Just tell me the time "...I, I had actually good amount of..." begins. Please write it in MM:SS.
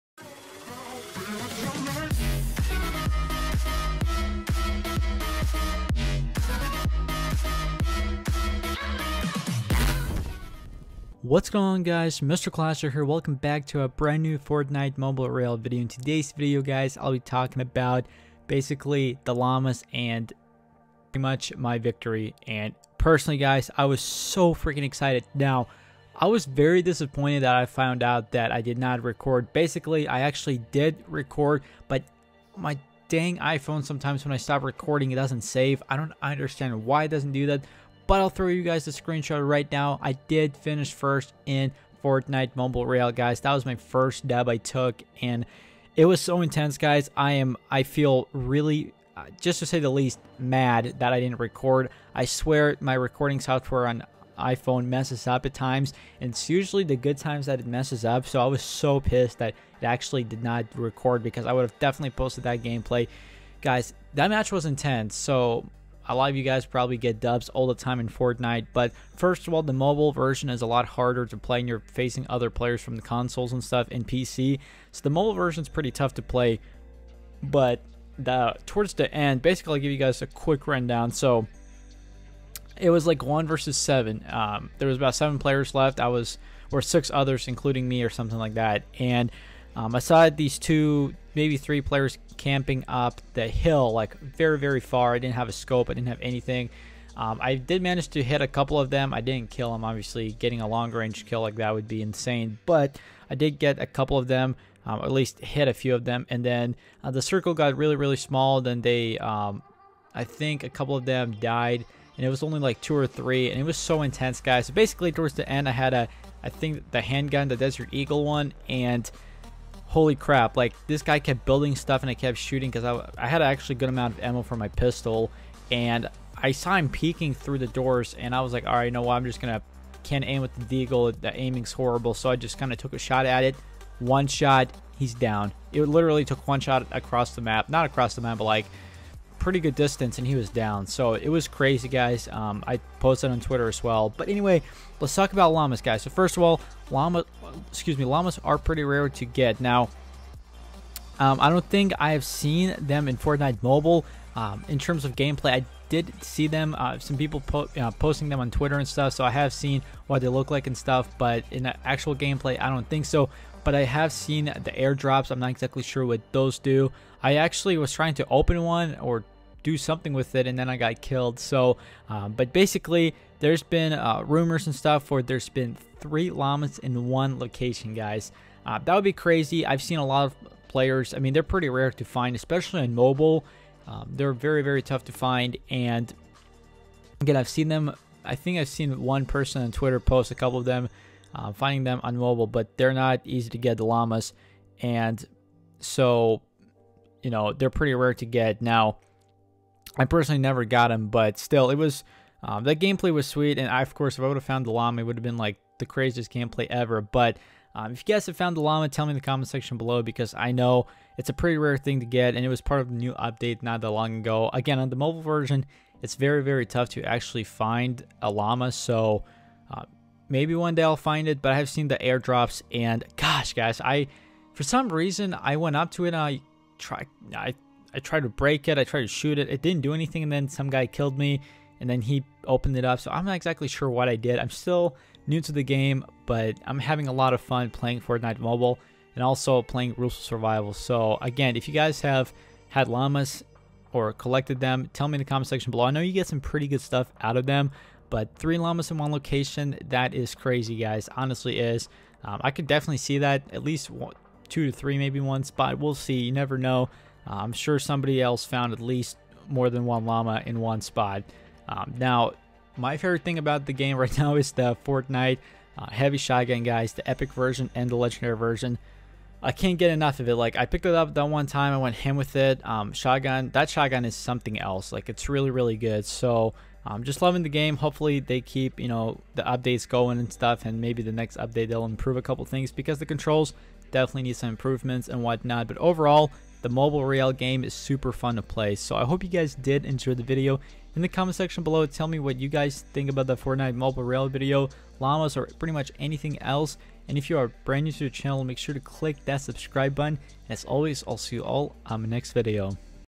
02:02.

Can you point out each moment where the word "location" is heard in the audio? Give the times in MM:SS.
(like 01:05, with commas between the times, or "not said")
02:57, 04:09.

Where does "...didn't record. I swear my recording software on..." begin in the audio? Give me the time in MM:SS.
00:51.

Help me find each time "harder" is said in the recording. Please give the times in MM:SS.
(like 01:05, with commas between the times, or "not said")
01:10.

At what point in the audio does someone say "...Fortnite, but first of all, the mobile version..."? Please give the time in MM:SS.
01:08.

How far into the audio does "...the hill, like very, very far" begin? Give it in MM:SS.
01:33.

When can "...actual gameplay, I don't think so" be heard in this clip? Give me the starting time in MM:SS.
02:41.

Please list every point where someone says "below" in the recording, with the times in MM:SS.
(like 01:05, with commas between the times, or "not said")
03:29, 04:05, 04:51.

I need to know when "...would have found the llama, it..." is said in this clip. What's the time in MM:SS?
03:24.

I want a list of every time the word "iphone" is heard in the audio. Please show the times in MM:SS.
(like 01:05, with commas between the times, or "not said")
00:33, 00:54.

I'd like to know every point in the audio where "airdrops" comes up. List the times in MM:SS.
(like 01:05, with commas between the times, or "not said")
02:44, 03:41.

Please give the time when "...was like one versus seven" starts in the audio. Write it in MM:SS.
01:22.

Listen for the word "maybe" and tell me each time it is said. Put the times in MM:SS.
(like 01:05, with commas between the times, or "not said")
01:31, 03:40, 04:14, 04:40.